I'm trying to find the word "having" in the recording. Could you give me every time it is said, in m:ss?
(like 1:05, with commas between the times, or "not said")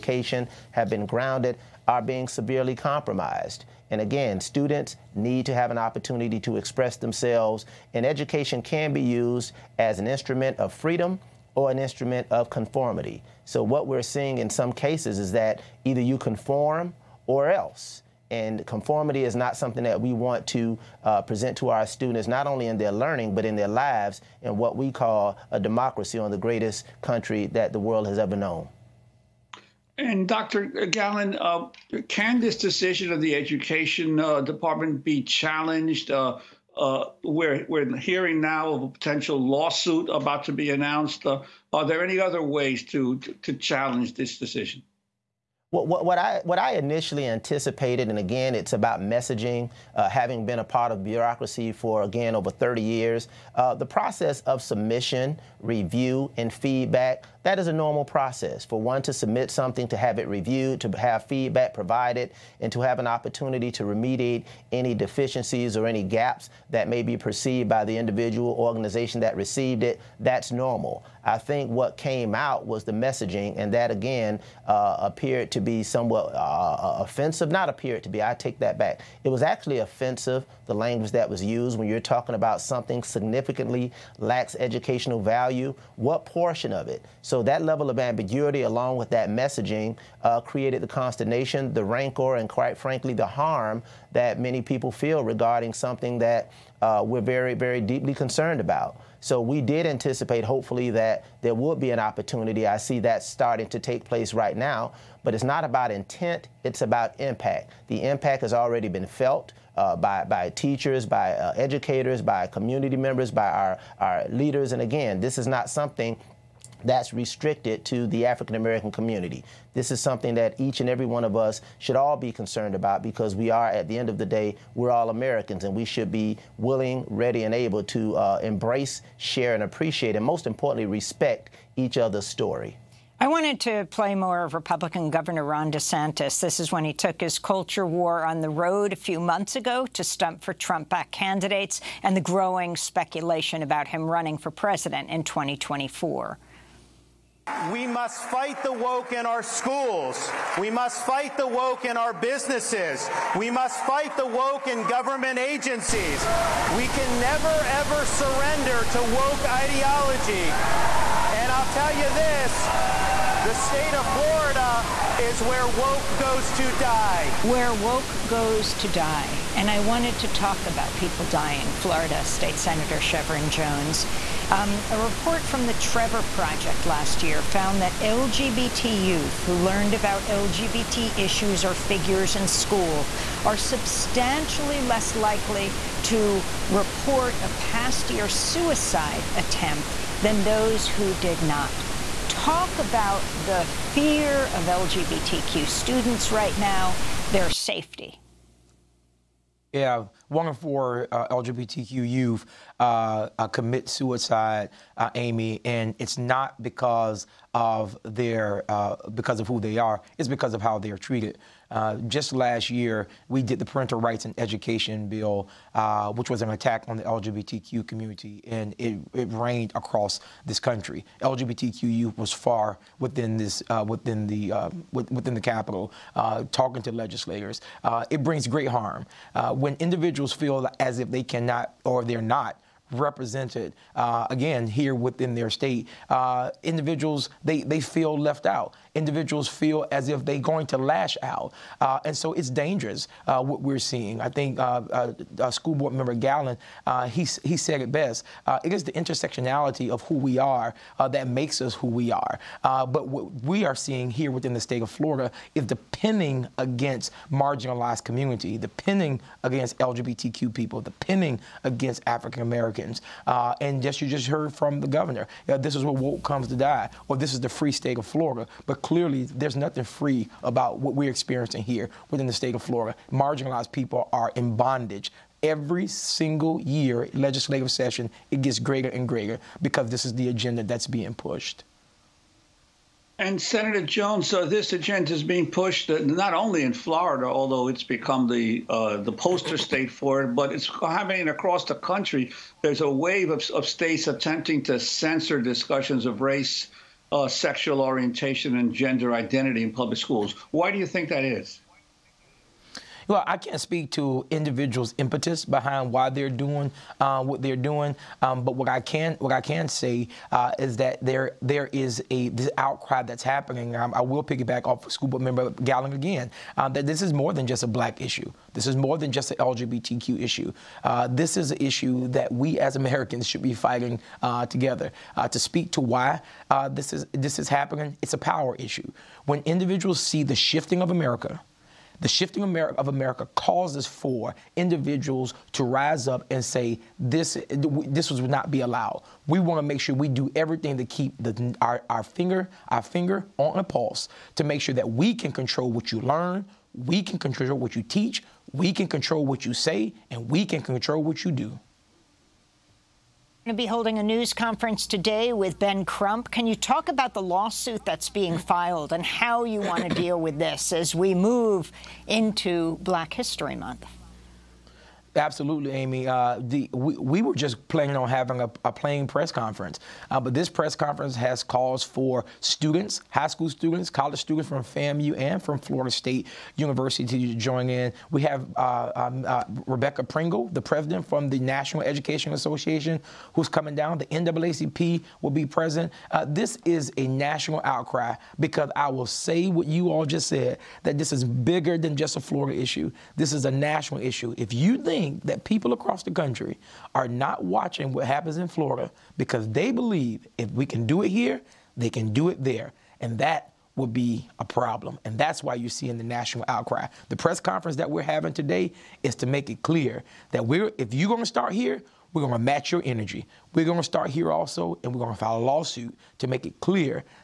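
0:50, 6:08, 6:48.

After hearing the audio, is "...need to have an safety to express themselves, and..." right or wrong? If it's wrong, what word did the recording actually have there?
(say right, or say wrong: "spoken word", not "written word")
wrong: "opportunity", not "safety".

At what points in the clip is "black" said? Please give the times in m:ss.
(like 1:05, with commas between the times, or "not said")
5:17, 6:02.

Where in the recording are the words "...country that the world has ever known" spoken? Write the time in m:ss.
0:27.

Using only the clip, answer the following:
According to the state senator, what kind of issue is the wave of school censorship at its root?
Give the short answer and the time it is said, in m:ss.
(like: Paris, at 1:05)
a power issue, at 5:28.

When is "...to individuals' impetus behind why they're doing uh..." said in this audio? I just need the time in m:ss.
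5:03.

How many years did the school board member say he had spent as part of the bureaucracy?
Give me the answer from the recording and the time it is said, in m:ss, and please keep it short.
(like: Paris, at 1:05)
over 30 years, at 0:52.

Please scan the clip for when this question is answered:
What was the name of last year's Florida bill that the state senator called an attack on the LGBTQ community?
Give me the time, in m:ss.
3:33.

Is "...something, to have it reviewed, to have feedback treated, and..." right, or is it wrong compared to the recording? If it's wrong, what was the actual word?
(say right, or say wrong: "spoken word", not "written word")
wrong: "provided", not "treated".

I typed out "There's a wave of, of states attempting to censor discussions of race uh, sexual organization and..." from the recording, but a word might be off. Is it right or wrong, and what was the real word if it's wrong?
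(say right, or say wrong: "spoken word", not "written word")
wrong: "orientation", not "organization".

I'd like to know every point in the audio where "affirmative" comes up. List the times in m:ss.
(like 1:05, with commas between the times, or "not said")
not said.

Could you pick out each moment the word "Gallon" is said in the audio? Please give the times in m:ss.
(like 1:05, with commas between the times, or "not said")
0:30, 4:06, 5:15.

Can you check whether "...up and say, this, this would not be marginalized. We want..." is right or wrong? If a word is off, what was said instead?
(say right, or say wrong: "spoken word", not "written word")
wrong: "allowed", not "marginalized".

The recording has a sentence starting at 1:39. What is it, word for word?
So we did anticipate, hopefully, that there would be an opportunity.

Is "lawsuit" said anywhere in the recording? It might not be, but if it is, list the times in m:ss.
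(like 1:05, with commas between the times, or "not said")
0:39, 5:57, 6:55.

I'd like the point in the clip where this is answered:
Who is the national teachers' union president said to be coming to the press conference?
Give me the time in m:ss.
6:19.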